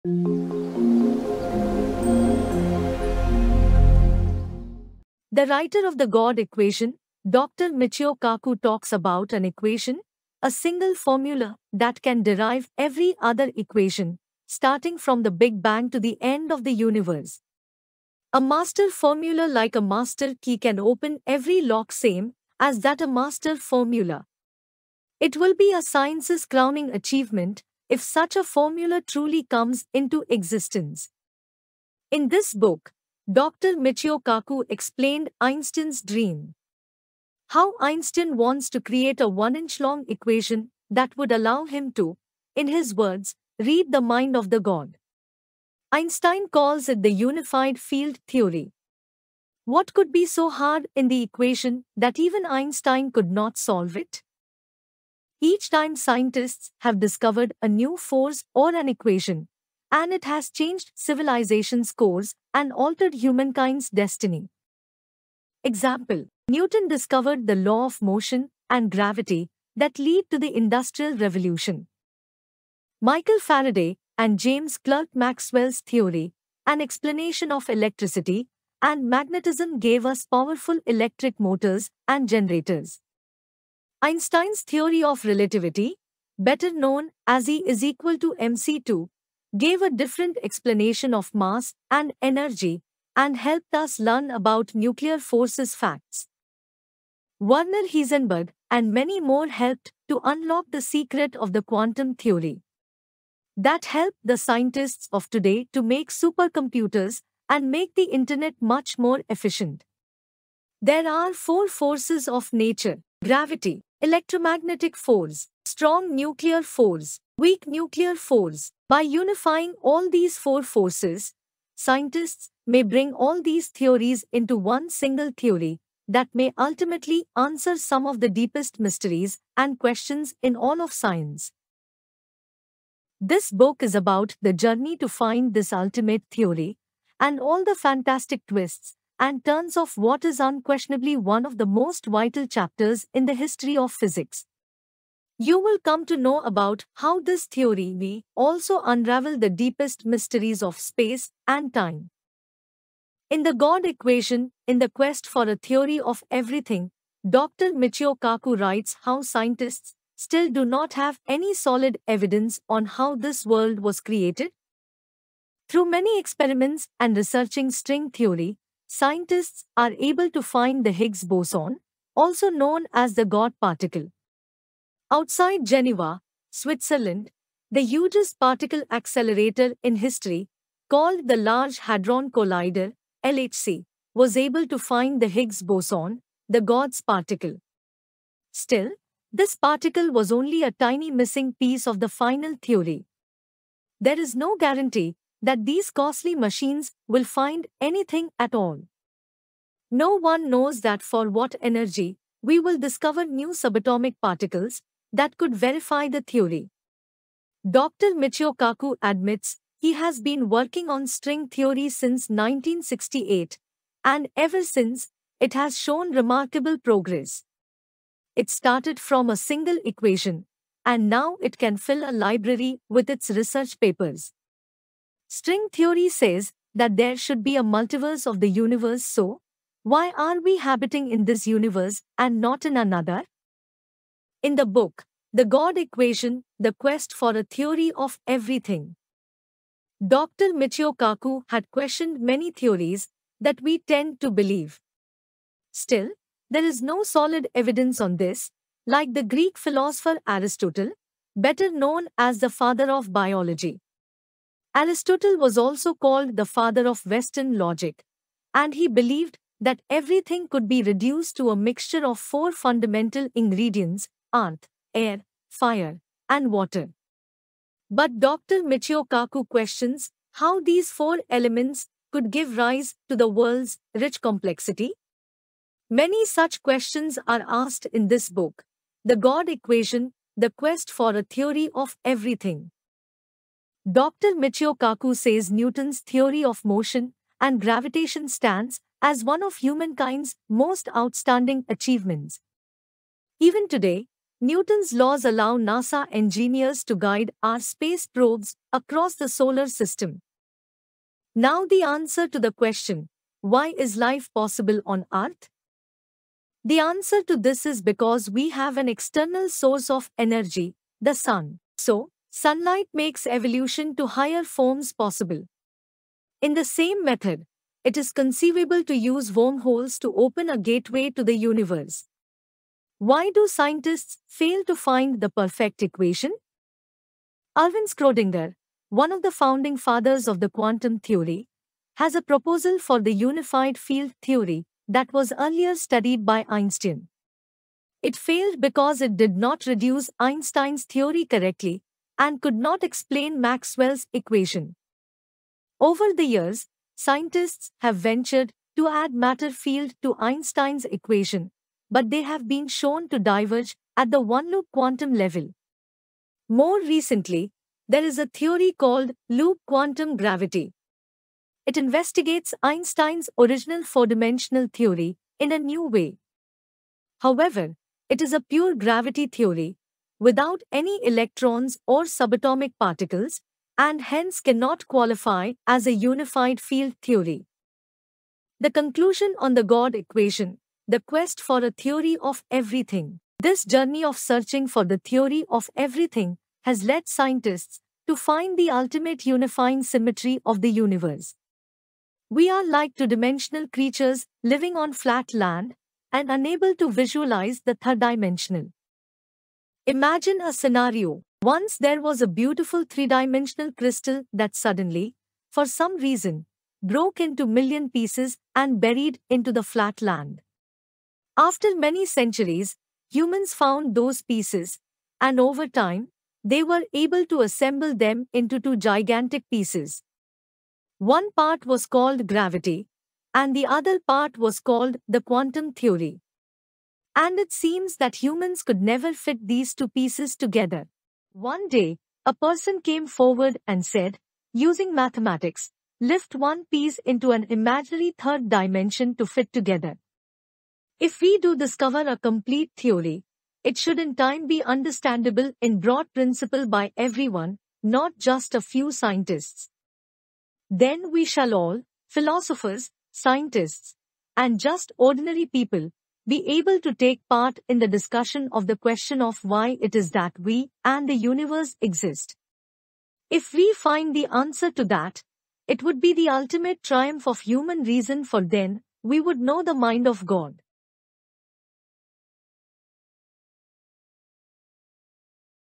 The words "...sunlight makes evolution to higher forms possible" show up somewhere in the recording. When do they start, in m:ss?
5:12.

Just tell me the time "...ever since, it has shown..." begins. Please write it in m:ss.
3:34.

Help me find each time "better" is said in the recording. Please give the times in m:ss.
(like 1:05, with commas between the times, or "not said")
1:26, 4:11.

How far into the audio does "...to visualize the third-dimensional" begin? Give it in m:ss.
6:36.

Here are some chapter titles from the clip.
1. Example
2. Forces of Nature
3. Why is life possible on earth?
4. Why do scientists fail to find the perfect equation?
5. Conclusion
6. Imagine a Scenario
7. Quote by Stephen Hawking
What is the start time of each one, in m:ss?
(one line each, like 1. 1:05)
1. 1:06
2. 1:50
3. 5:01
4. 5:21
5. 6:17
6. 6:39
7. 7:20.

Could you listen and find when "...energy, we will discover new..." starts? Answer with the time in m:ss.
3:21.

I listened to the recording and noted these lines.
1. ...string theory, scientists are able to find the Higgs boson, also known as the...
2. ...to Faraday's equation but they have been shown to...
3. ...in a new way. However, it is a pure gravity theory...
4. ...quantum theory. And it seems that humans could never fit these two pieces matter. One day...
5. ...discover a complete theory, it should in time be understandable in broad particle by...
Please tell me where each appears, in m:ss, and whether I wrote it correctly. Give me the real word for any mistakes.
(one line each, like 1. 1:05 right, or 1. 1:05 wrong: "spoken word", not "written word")
1. 2:47 right
2. 5:50 wrong: "Einstein", not "Faraday"
3. 6:05 right
4. 7:05 wrong: "together", not "matter"
5. 7:21 wrong: "principle", not "particle".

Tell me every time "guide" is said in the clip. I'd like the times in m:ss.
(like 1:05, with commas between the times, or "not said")
4:56.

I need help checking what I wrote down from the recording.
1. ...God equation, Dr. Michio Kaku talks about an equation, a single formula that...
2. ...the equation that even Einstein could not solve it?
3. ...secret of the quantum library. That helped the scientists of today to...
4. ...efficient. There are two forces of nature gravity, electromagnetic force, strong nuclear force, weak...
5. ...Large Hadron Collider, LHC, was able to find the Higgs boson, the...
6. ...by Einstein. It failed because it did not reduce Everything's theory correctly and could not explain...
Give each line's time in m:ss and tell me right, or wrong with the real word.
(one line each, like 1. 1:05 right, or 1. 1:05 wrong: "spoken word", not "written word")
1. 0:06 right
2. 0:51 right
3. 1:40 wrong: "theory", not "library"
4. 1:49 wrong: "four", not "two"
5. 3:01 right
6. 5:36 wrong: "Einstein", not "Everything".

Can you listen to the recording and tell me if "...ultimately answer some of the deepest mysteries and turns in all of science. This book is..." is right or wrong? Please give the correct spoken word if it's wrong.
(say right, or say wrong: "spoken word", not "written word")
wrong: "questions", not "turns".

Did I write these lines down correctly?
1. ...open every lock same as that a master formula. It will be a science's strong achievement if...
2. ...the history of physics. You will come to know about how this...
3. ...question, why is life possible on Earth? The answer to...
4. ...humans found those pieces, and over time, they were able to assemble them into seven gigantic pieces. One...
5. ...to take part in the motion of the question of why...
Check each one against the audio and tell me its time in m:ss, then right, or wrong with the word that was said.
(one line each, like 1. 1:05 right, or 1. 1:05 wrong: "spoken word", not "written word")
1. 0:20 wrong: "crowning", not "strong"
2. 2:23 right
3. 5:02 right
4. 6:53 wrong: "two", not "seven"
5. 7:36 wrong: "discussion", not "motion".